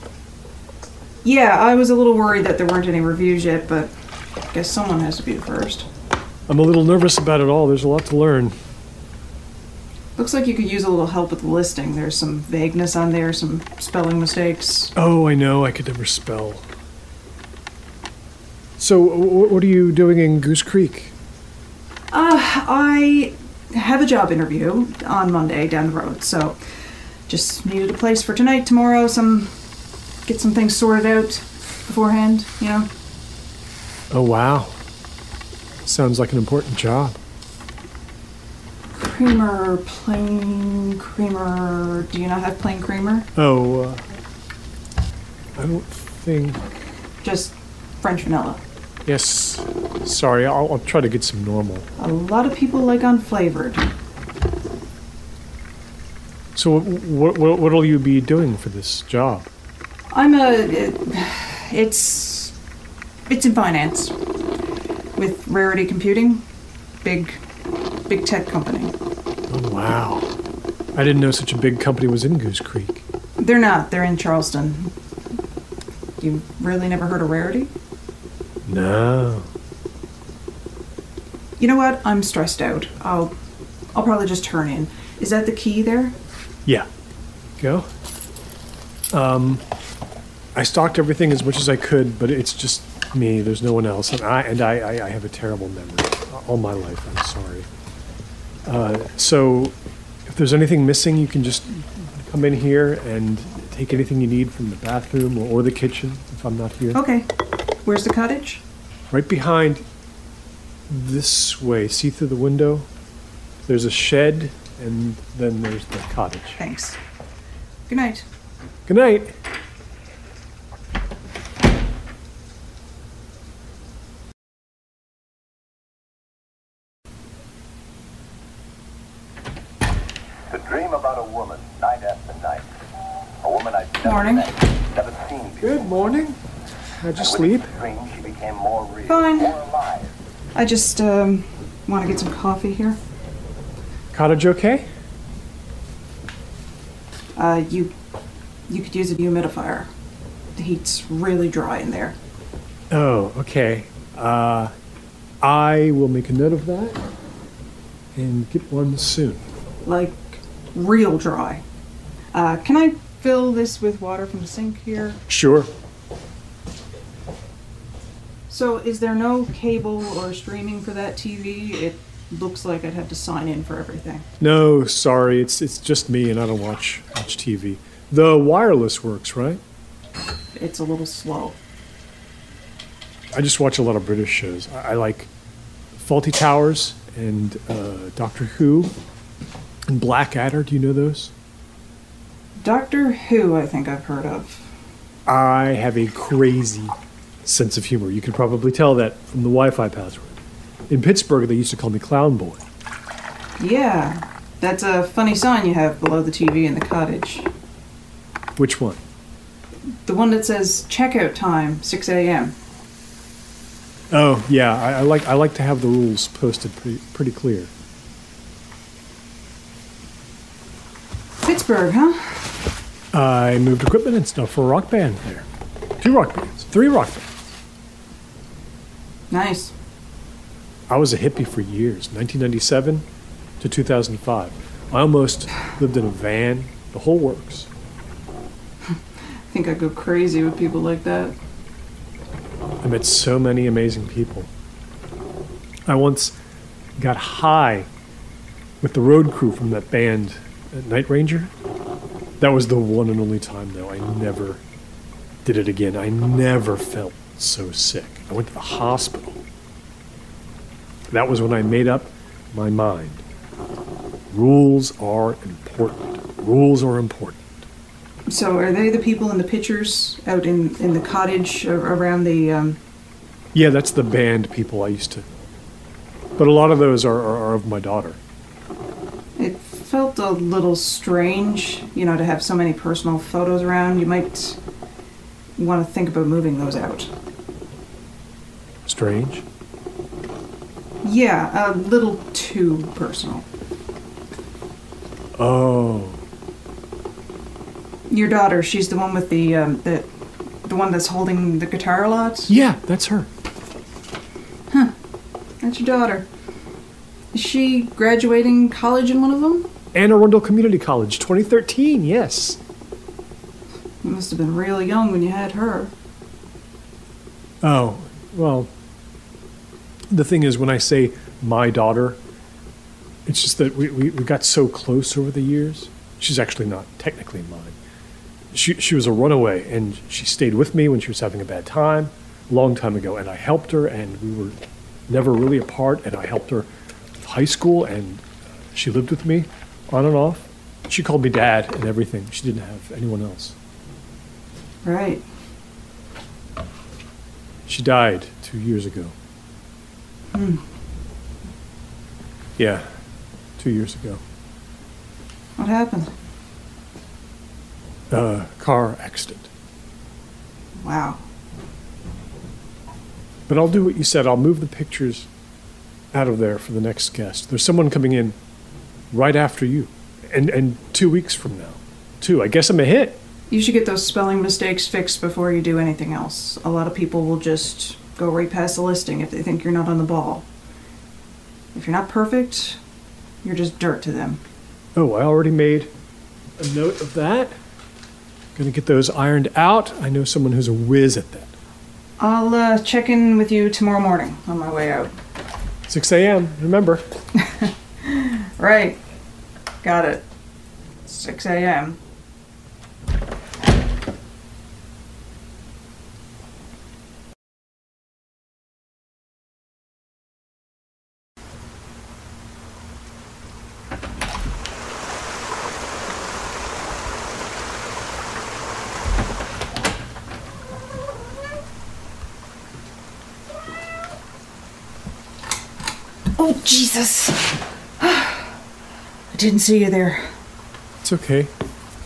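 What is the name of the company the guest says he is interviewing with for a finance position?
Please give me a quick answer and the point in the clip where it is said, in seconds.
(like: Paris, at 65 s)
Rarity Computing, at 65 s.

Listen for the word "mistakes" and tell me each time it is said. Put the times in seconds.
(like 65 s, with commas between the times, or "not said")
14 s, 374 s.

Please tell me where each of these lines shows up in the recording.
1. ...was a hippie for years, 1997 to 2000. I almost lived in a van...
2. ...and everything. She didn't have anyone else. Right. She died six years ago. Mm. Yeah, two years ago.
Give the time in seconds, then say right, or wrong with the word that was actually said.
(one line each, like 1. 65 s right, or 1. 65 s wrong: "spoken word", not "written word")
1. 230 s wrong: "2005", not "2000"
2. 341 s wrong: "two", not "six".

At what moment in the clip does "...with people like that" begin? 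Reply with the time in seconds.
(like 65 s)
240 s.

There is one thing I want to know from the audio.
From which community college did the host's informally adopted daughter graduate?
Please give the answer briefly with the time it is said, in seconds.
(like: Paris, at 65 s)
Anne Arundel Community College, at 309 s.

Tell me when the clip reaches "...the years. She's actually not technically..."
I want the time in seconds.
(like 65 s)
325 s.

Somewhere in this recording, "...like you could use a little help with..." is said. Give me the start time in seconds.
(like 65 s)
10 s.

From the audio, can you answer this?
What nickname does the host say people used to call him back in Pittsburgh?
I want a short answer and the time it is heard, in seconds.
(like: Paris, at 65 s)
Clown Boy, at 201 s.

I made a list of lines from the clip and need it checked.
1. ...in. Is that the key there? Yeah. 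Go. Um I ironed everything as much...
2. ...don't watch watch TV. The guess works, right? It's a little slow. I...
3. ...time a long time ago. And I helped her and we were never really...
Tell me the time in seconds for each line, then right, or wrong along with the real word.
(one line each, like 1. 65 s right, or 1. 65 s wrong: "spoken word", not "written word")
1. 84 s wrong: "stalked", not "ironed"
2. 176 s wrong: "wireless", not "guess"
3. 331 s right.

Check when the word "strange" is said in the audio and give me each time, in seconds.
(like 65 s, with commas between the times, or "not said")
280 s, 288 s.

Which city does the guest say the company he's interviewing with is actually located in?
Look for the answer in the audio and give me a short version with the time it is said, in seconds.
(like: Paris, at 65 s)
Charleston, at 74 s.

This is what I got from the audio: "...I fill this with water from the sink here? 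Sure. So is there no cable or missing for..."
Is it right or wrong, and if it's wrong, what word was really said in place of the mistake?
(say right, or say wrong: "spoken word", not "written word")
wrong: "streaming", not "missing".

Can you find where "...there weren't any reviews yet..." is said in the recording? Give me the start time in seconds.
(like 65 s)
2 s.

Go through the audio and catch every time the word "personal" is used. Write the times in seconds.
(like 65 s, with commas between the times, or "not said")
282 s, 292 s.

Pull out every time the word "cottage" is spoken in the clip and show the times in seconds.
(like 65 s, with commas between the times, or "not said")
108 s, 115 s, 144 s, 206 s, 270 s.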